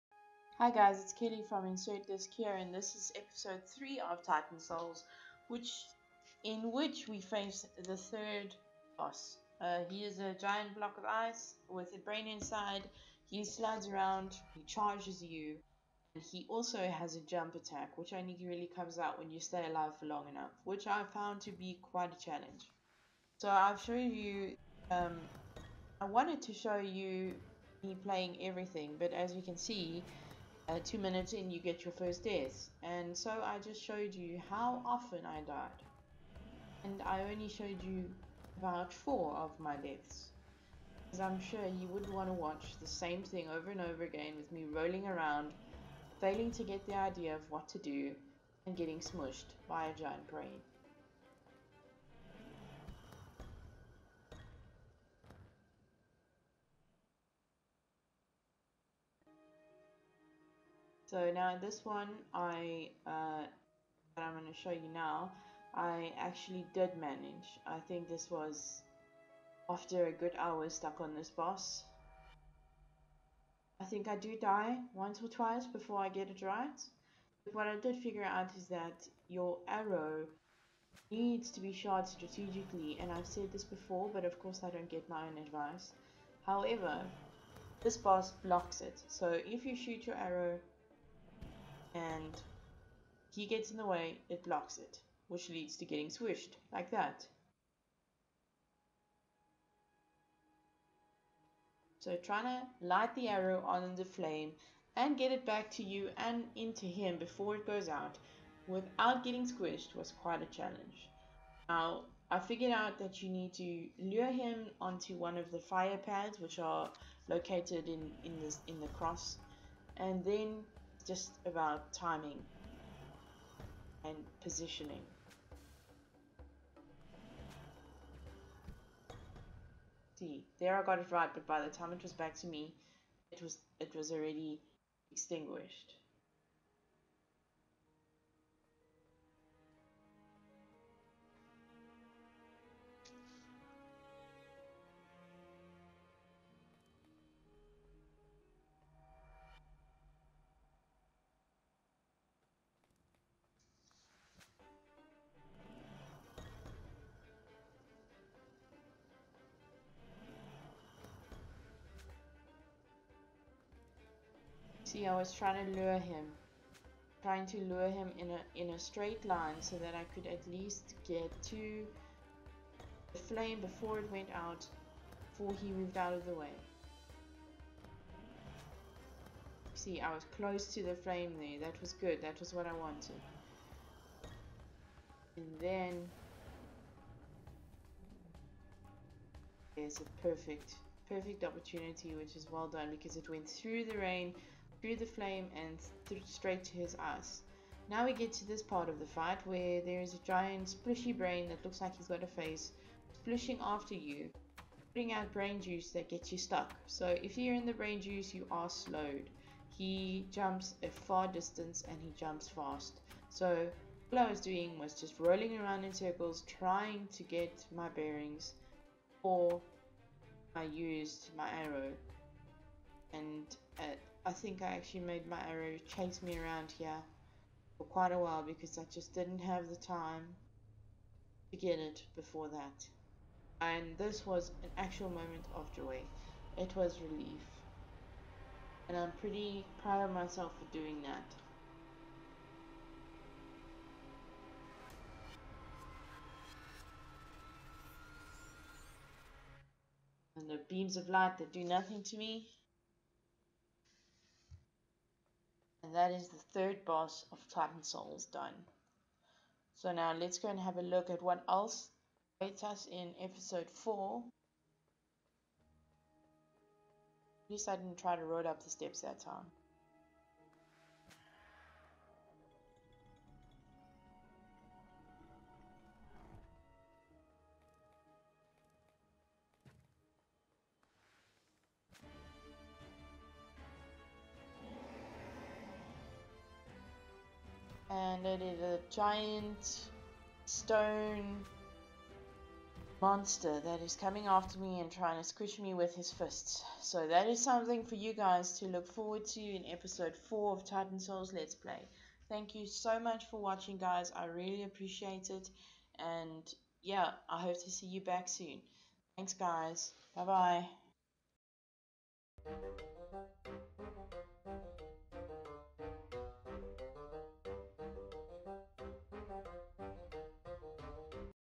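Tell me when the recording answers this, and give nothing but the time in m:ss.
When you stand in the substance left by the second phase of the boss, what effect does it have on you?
3:28.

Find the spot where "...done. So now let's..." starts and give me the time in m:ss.
4:18.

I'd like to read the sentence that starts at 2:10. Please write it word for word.
See, there I got it right, but by the time it was back to me, it was it was already extinguished.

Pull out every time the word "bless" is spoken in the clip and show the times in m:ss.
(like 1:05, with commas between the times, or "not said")
not said.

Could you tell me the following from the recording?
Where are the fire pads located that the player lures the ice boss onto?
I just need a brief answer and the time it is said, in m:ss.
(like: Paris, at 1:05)
in the cross, at 1:58.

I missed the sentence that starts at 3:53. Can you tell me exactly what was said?
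And this was an actual moment of joy.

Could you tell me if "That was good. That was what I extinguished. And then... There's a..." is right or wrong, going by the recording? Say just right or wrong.
wrong.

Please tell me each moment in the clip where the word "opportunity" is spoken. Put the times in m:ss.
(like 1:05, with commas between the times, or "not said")
3:11.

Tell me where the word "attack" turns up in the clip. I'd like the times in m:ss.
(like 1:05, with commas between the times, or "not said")
0:17.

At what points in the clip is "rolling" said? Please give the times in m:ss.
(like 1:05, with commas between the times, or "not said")
0:44, 3:35.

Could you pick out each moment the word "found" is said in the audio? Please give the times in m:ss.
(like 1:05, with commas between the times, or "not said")
0:21.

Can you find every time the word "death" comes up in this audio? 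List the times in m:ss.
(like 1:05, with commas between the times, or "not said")
0:32, 0:39.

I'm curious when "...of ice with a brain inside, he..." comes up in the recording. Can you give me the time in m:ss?
0:10.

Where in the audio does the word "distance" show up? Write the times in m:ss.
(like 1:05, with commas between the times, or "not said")
3:31.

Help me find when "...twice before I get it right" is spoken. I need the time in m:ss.
1:15.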